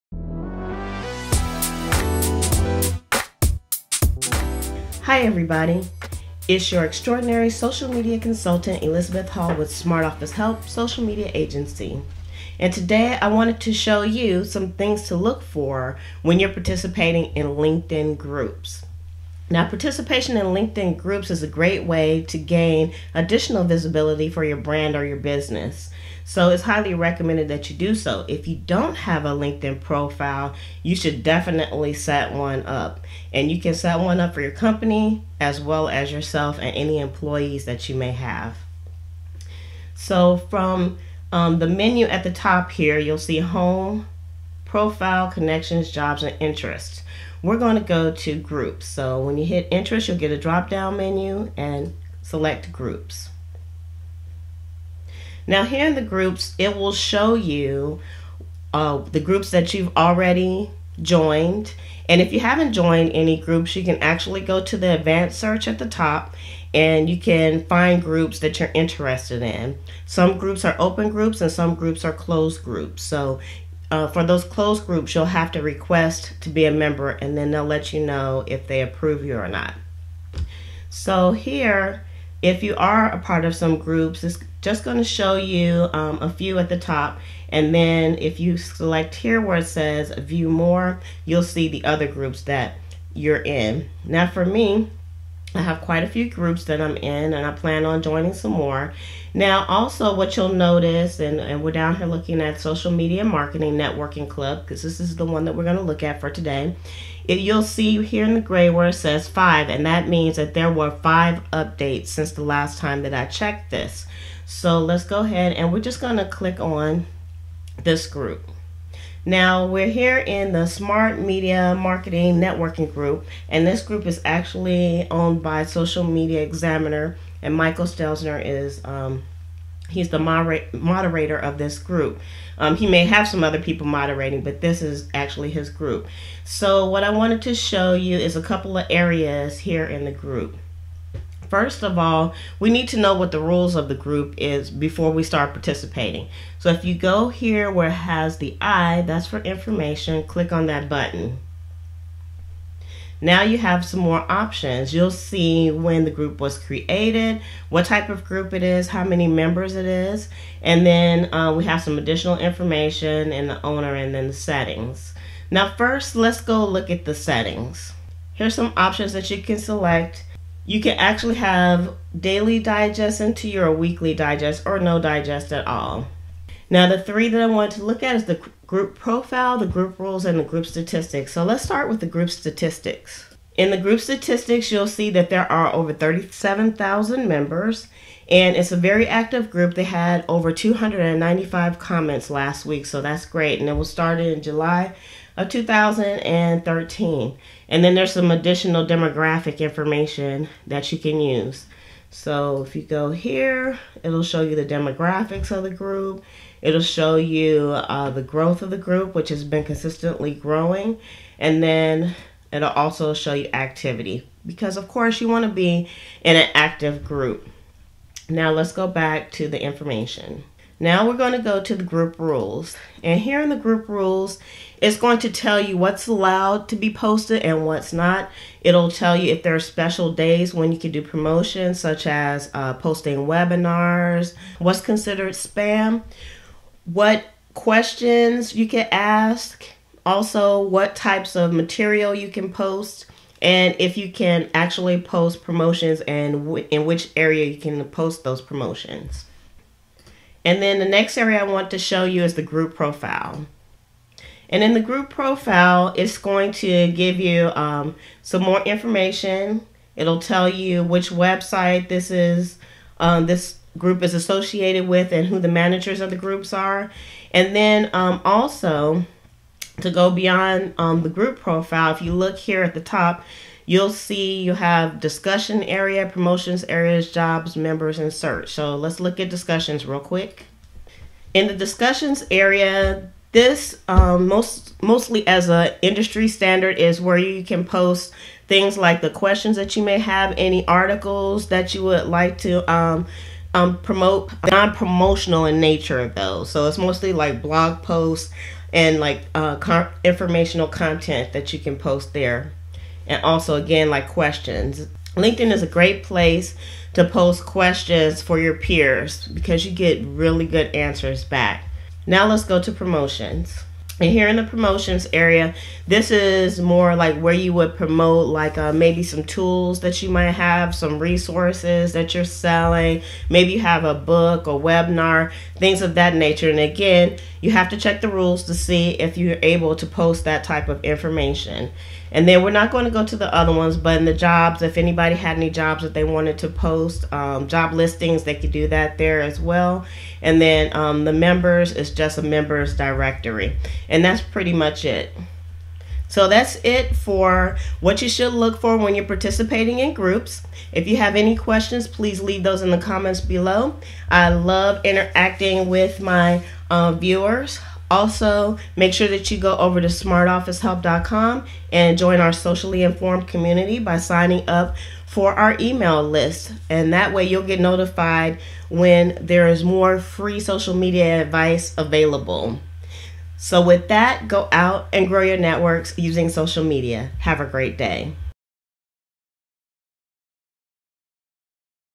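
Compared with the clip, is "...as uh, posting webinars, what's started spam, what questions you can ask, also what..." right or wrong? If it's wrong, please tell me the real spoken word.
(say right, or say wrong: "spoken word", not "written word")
wrong: "considered", not "started".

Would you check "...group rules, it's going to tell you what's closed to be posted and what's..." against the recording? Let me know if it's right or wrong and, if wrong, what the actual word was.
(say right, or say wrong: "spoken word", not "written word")
wrong: "allowed", not "closed".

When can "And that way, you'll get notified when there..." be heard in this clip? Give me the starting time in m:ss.
6:06.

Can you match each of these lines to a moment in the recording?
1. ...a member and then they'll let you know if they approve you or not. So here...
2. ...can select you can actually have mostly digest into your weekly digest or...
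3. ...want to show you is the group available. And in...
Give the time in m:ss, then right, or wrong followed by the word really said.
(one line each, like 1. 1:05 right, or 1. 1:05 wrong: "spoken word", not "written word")
1. 1:16 right
2. 2:49 wrong: "daily", not "mostly"
3. 4:11 wrong: "profile", not "available".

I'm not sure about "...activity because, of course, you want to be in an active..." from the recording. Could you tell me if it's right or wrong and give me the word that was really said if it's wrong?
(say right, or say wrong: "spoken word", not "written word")
right.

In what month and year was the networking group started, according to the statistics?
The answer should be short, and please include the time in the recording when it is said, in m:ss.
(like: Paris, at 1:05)
July 2013, at 3:14.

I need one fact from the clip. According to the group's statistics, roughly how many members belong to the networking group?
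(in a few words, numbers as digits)
37,000.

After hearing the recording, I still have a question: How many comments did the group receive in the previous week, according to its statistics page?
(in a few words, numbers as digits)
295.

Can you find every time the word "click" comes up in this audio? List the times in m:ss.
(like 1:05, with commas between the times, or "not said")
1:56, 2:30.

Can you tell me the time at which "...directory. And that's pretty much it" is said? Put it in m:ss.
5:42.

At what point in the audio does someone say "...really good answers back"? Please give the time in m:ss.
5:10.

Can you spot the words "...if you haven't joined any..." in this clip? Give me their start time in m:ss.
1:02.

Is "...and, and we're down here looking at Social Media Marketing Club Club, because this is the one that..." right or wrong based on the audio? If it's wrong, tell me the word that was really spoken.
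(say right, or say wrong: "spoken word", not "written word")
wrong: "Networking", not "Club".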